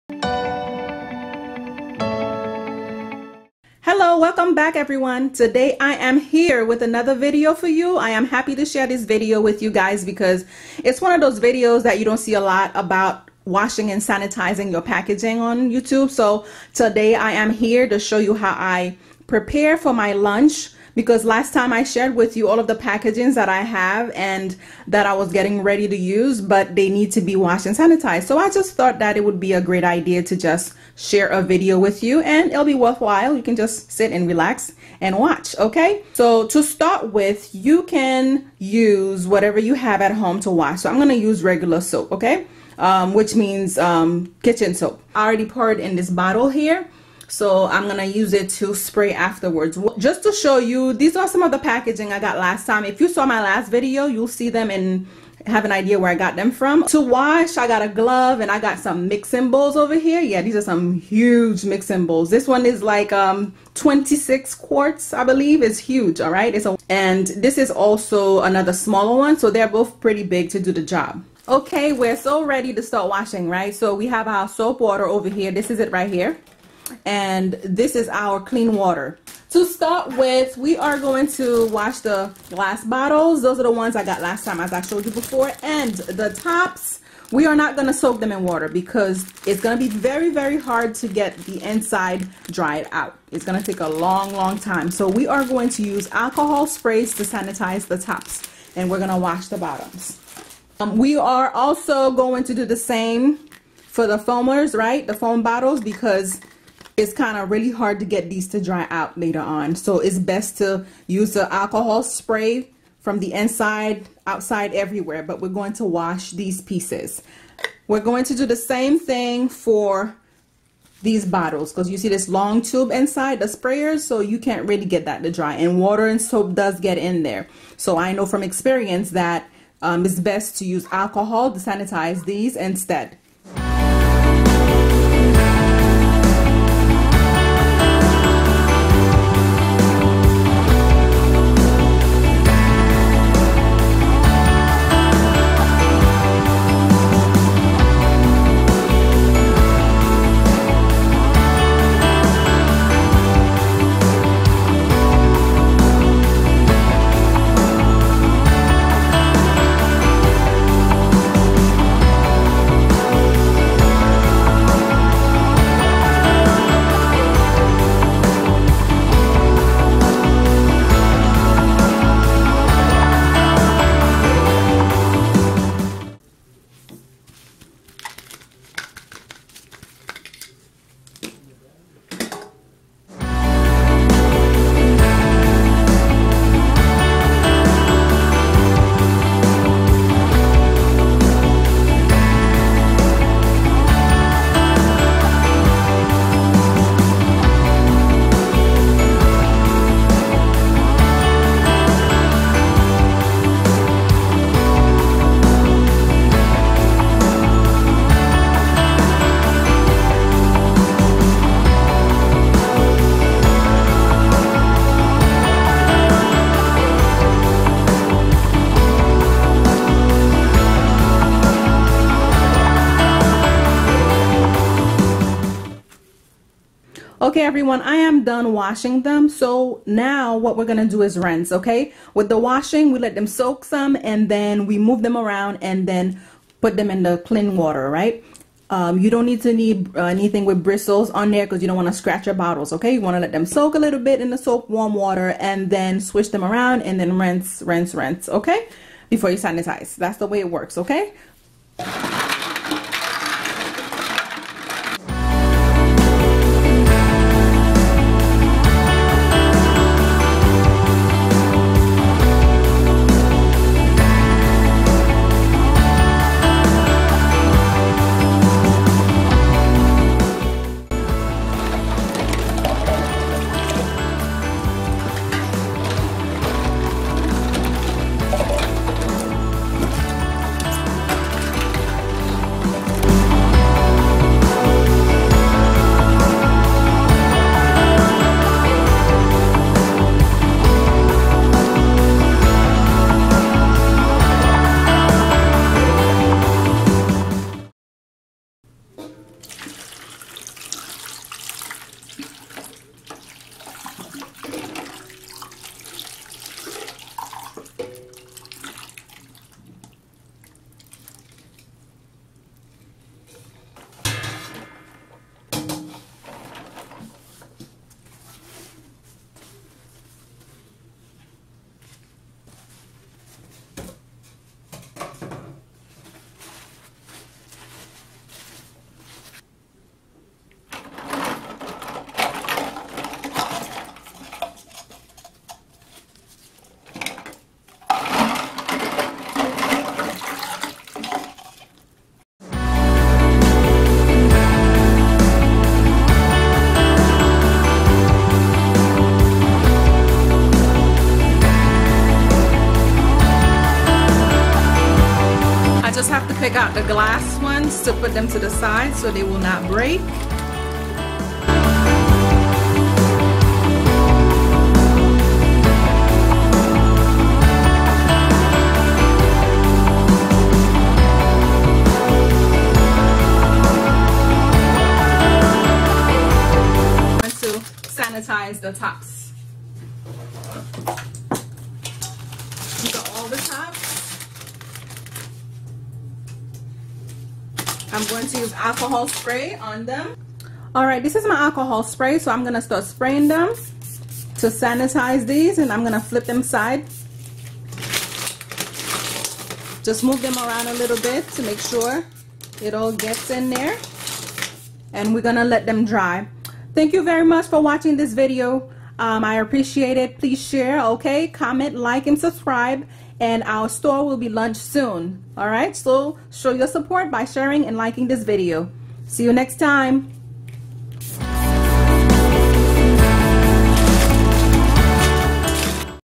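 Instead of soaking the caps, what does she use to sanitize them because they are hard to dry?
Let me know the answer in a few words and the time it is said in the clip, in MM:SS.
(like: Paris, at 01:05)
alcohol sprays, at 01:36.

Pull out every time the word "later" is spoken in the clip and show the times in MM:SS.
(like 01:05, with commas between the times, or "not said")
01:49.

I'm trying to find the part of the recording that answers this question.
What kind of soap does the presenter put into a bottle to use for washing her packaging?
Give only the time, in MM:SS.
00:44.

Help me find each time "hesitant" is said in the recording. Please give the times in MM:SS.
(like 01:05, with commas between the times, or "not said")
not said.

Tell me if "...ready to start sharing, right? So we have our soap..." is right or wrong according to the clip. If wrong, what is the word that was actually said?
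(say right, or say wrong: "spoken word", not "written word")
wrong: "washing", not "sharing".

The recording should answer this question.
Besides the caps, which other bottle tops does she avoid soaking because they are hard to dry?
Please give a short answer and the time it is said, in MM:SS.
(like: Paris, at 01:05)
foamers, at 01:44.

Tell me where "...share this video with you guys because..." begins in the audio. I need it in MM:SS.
00:08.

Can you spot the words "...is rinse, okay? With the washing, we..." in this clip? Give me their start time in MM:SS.
03:51.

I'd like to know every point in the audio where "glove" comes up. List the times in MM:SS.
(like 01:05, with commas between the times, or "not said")
00:57.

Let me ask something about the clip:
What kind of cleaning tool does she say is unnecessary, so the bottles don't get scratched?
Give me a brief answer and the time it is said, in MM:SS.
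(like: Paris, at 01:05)
bristles, at 04:00.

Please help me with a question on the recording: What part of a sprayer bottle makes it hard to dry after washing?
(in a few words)
long tube.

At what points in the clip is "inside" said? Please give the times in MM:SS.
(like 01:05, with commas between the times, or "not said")
01:31, 01:53, 02:02.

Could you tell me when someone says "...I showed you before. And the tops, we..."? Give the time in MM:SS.
01:24.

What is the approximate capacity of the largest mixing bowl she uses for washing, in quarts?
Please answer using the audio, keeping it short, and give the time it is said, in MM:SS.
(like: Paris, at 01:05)
26, at 01:03.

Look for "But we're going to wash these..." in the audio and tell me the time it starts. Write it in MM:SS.
01:55.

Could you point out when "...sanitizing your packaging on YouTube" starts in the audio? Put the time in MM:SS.
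00:14.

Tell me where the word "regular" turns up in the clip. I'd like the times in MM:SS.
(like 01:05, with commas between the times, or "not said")
00:41.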